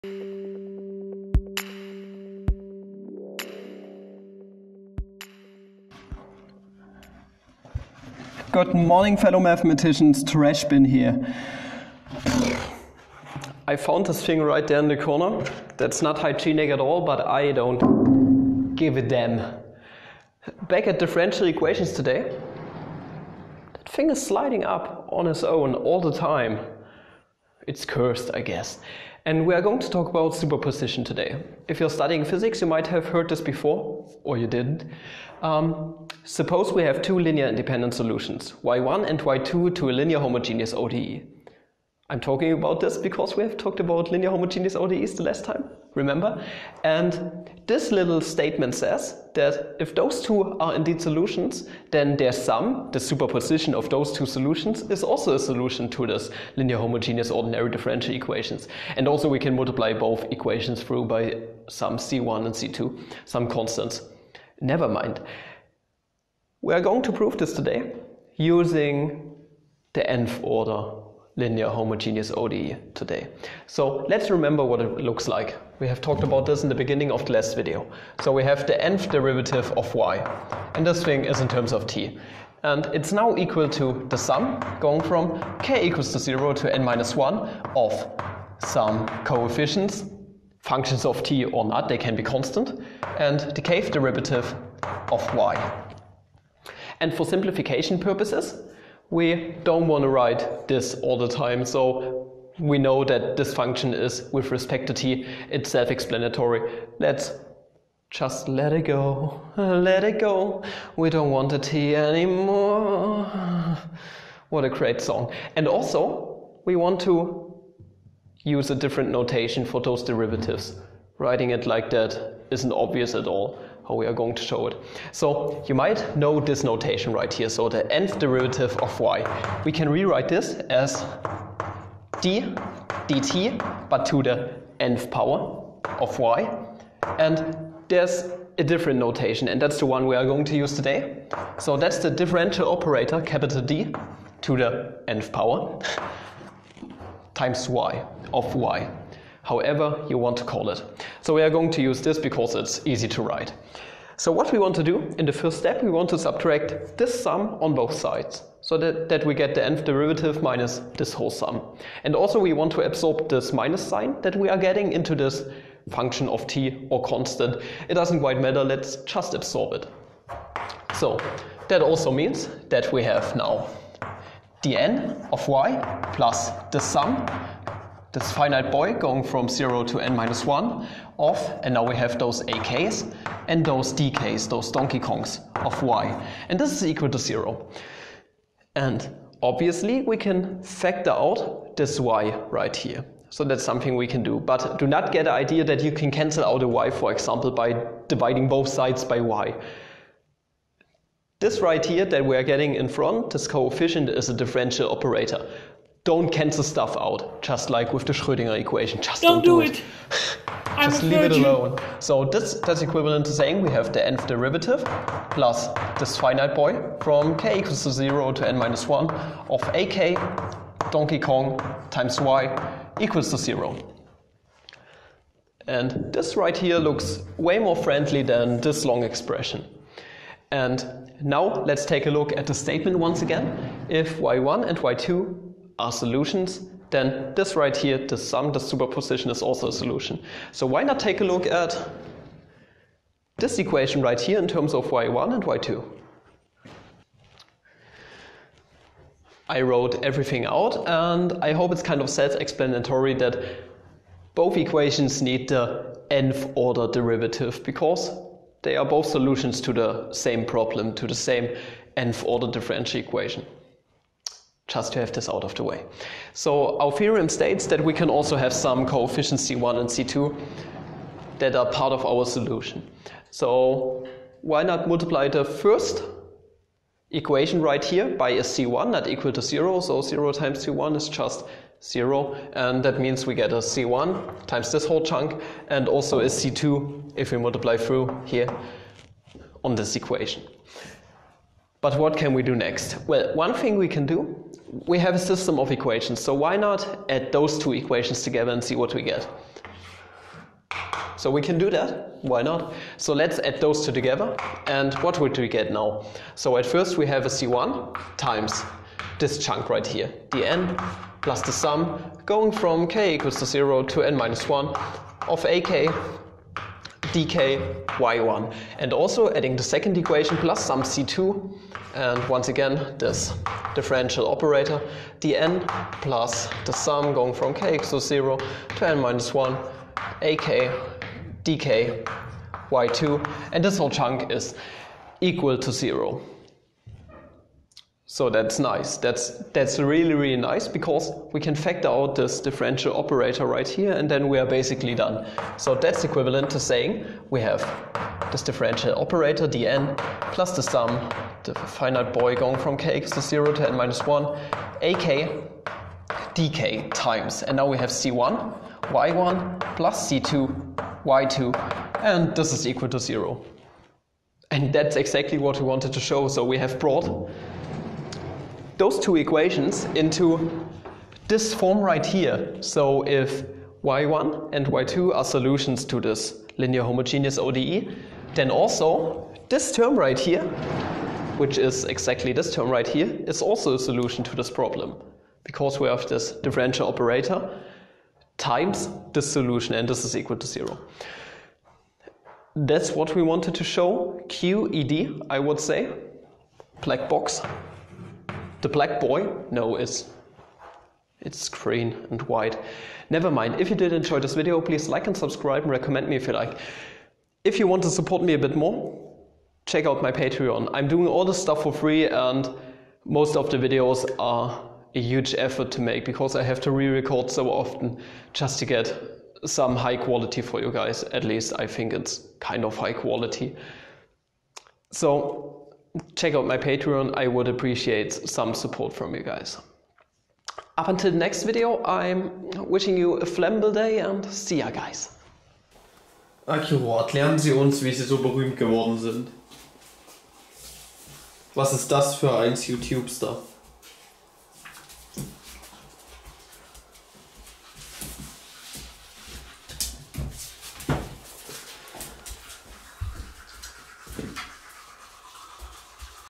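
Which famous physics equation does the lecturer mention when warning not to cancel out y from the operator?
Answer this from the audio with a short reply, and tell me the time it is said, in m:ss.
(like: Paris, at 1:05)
Schrödinger equation, at 3:28.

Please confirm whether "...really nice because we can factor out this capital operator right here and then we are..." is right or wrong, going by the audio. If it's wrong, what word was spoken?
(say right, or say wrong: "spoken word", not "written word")
wrong: "differential", not "capital".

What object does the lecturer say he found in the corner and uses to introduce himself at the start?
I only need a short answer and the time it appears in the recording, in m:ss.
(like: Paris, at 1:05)
Trash bin, at 0:10.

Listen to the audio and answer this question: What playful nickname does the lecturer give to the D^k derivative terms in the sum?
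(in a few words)
Donkey Kongs.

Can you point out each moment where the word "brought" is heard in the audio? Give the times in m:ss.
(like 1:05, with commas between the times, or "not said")
6:06.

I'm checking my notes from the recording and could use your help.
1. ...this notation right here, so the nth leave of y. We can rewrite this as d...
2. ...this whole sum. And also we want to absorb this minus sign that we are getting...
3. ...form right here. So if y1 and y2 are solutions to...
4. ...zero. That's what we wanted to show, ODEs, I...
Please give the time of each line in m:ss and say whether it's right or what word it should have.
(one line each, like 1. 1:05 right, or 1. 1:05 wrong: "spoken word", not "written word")
1. 2:06 wrong: "derivative", not "leave"
2. 2:40 right
3. 6:11 right
4. 6:30 wrong: "QED", not "ODEs".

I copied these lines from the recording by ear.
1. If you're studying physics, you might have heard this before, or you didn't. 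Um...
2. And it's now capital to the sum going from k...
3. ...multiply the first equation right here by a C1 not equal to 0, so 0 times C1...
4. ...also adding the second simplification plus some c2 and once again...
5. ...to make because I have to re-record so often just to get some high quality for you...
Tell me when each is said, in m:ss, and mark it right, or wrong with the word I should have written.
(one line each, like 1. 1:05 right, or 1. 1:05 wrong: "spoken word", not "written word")
1. 0:31 right
2. 1:22 wrong: "equal", not "capital"
3. 4:34 right
4. 5:18 wrong: "equation", not "simplification"
5. 6:55 right.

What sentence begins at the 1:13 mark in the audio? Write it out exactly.
So let's remember what it looks like.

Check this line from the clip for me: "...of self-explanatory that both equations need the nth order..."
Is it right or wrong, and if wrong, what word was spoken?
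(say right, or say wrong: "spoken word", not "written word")
right.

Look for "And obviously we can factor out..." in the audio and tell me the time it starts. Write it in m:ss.
3:08.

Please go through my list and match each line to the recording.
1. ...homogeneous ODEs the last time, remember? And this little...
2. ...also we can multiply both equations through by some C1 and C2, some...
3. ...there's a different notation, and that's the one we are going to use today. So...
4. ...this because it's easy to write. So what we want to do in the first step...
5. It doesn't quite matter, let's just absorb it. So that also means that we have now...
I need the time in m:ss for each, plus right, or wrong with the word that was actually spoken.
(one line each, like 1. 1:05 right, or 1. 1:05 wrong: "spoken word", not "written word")
1. 0:44 right
2. 0:59 right
3. 2:17 right
4. 2:32 right
5. 2:47 right.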